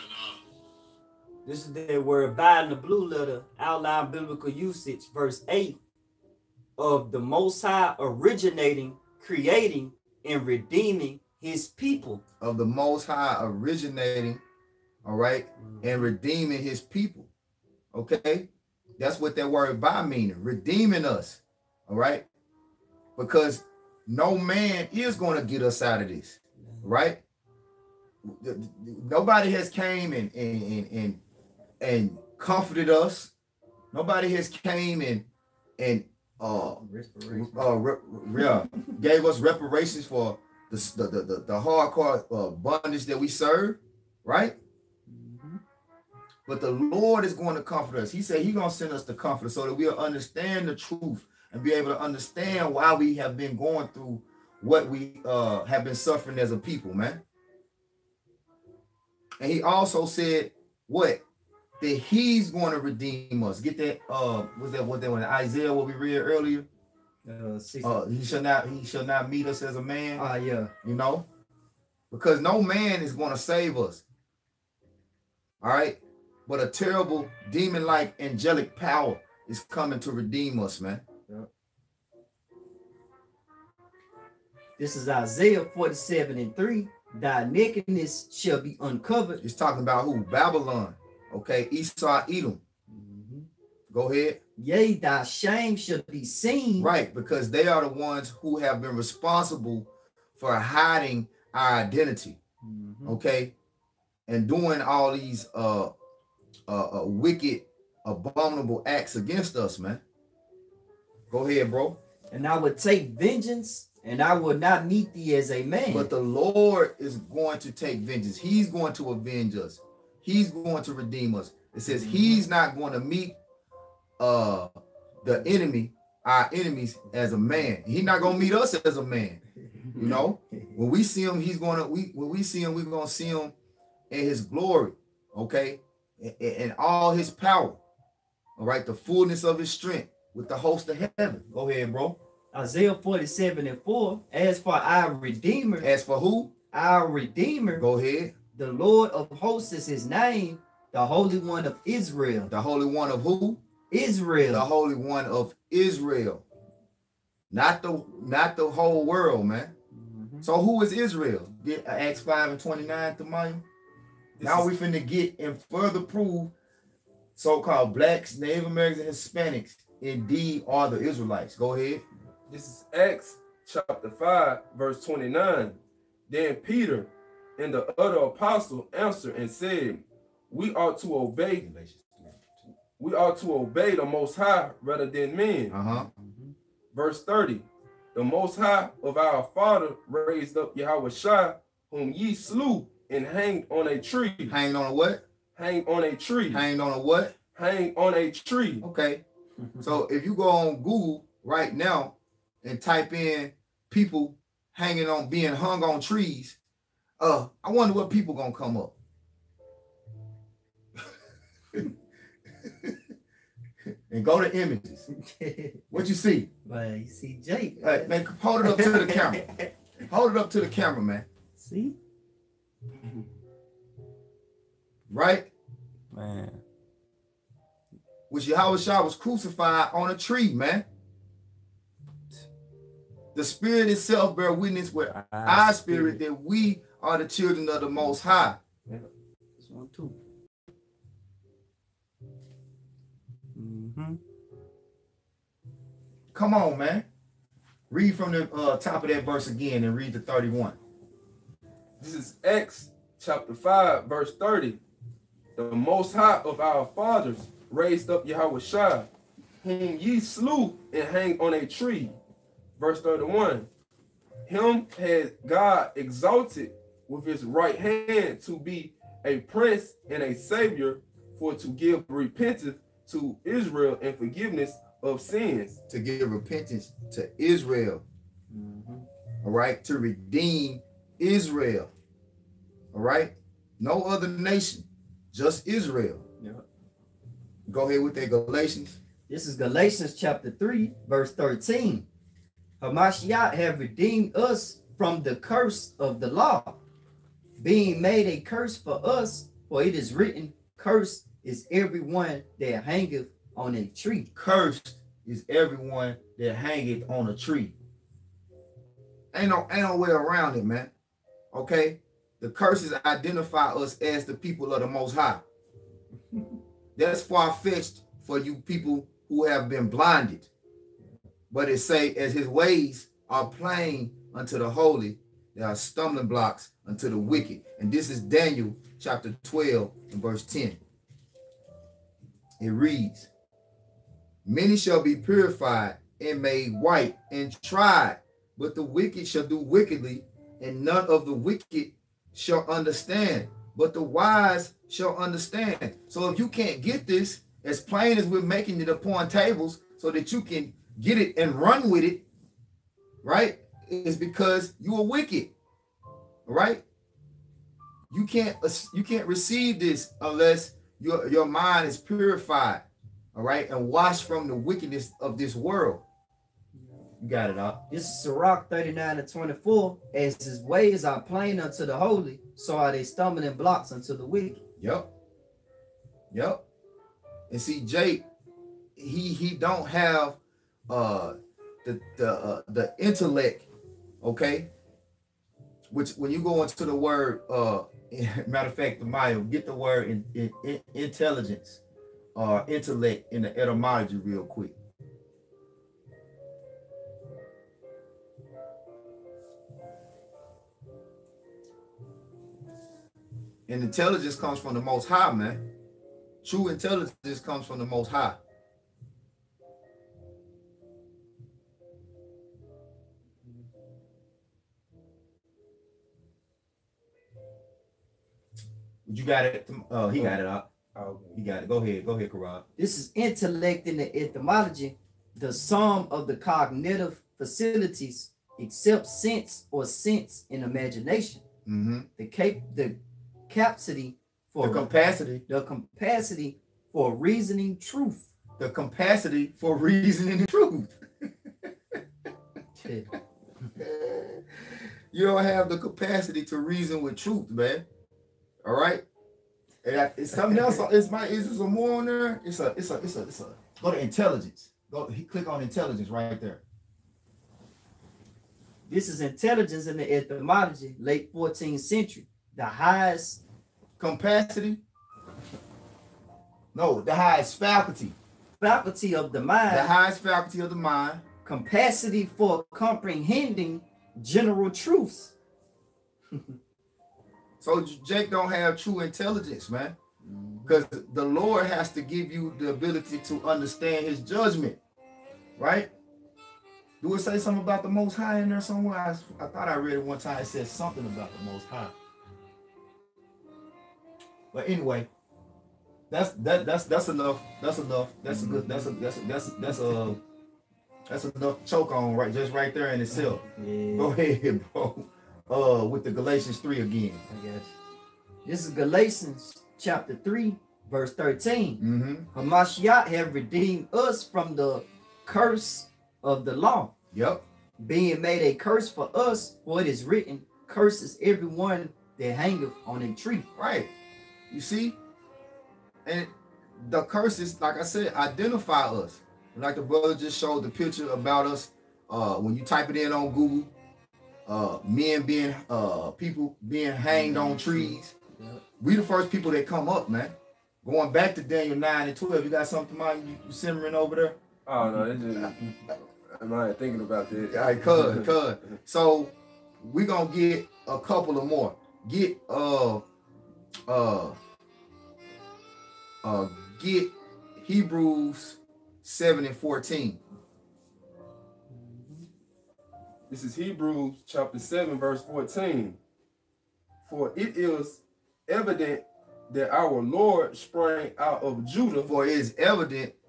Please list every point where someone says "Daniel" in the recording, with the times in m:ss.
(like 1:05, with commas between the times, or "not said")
5:28, 9:01.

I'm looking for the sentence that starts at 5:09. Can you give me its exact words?
Ain't no ain't no way around it, man.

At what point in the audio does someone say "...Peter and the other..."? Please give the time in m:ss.
2:56.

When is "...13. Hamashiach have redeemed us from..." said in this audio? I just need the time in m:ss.
4:51.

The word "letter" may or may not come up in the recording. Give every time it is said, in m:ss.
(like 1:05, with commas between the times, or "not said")
0:03.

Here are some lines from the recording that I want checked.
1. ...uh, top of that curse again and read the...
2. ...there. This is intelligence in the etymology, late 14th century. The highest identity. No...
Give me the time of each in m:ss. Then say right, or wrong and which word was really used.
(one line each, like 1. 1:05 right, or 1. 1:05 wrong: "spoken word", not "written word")
1. 4:08 wrong: "verse", not "curse"
2. 7:36 wrong: "capacity", not "identity".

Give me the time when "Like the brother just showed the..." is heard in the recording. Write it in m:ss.
8:49.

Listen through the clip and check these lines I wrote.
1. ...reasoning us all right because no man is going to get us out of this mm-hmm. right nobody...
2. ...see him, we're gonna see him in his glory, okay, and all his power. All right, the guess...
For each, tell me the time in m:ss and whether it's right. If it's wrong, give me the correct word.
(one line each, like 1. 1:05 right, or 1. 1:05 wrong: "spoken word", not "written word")
1. 0:20 wrong: "redeeming", not "reasoning"
2. 2:12 wrong: "fullness", not "guess".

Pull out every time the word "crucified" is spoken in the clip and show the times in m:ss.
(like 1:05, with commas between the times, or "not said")
3:49.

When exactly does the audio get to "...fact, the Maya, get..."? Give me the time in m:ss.
6:28.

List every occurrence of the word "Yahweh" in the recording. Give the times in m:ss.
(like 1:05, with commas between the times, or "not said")
3:10, 3:48, 4:18.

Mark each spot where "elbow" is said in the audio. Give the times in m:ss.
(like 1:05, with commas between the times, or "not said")
not said.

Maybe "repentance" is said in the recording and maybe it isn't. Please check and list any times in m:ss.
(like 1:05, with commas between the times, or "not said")
4:32, 4:36.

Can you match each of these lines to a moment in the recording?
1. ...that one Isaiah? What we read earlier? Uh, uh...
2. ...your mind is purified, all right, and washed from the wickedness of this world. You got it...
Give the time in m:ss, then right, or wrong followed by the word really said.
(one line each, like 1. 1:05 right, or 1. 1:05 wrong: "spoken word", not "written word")
1. 1:05 right
2. 6:01 right.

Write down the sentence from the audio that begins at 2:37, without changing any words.
Not the not the whole world, man.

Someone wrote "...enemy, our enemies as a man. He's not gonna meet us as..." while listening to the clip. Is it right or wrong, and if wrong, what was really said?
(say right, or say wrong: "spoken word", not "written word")
right.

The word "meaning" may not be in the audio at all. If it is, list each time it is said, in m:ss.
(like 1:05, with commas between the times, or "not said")
0:20.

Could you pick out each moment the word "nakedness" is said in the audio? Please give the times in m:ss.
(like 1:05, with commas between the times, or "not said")
1:27.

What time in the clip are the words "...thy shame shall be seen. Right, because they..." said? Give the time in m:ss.
1:34.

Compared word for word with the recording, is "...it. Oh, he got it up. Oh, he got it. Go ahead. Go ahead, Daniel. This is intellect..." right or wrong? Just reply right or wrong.
wrong.